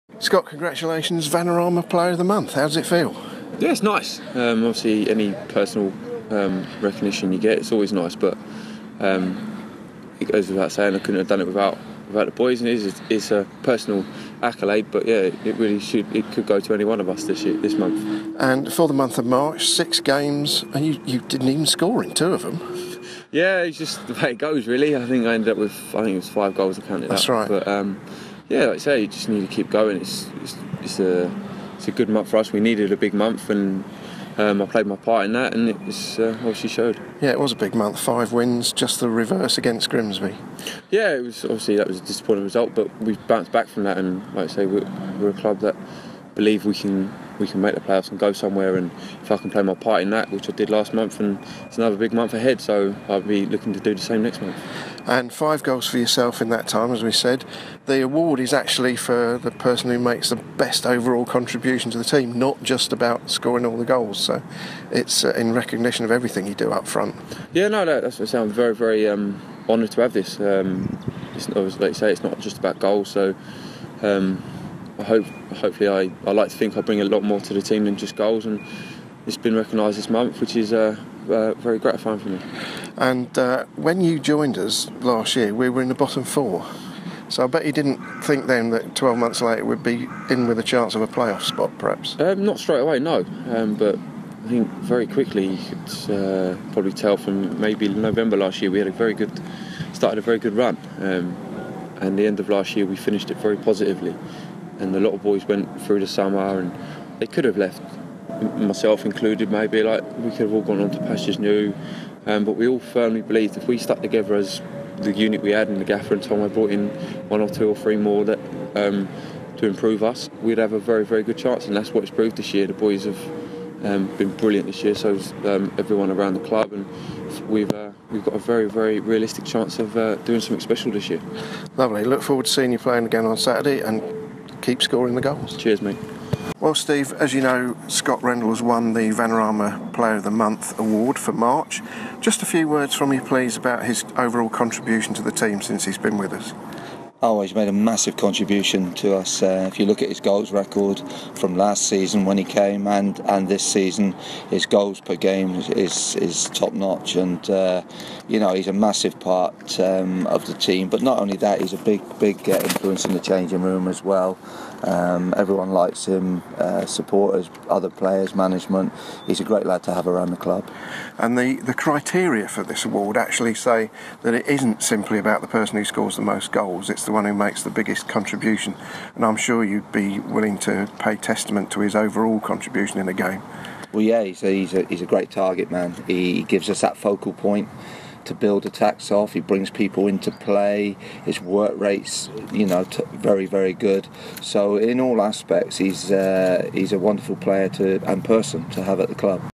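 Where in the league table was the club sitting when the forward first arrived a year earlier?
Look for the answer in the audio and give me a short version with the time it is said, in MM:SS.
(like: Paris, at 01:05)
Bottom four, at 01:25.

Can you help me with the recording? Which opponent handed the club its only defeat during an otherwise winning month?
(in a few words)
Grimsby.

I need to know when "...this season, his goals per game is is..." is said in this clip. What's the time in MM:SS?
02:33.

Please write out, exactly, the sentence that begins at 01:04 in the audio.
So it's uh, in recognition of everything you do up front.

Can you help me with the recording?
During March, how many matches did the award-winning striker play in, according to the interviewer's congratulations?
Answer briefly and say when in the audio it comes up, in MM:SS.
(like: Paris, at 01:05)
6, at 00:19.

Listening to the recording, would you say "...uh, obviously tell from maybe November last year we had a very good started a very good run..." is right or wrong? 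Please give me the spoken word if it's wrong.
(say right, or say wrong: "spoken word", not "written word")
wrong: "probably", not "obviously".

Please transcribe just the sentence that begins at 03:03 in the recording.
Well, yeah, he's a, he's a, he's a great target man.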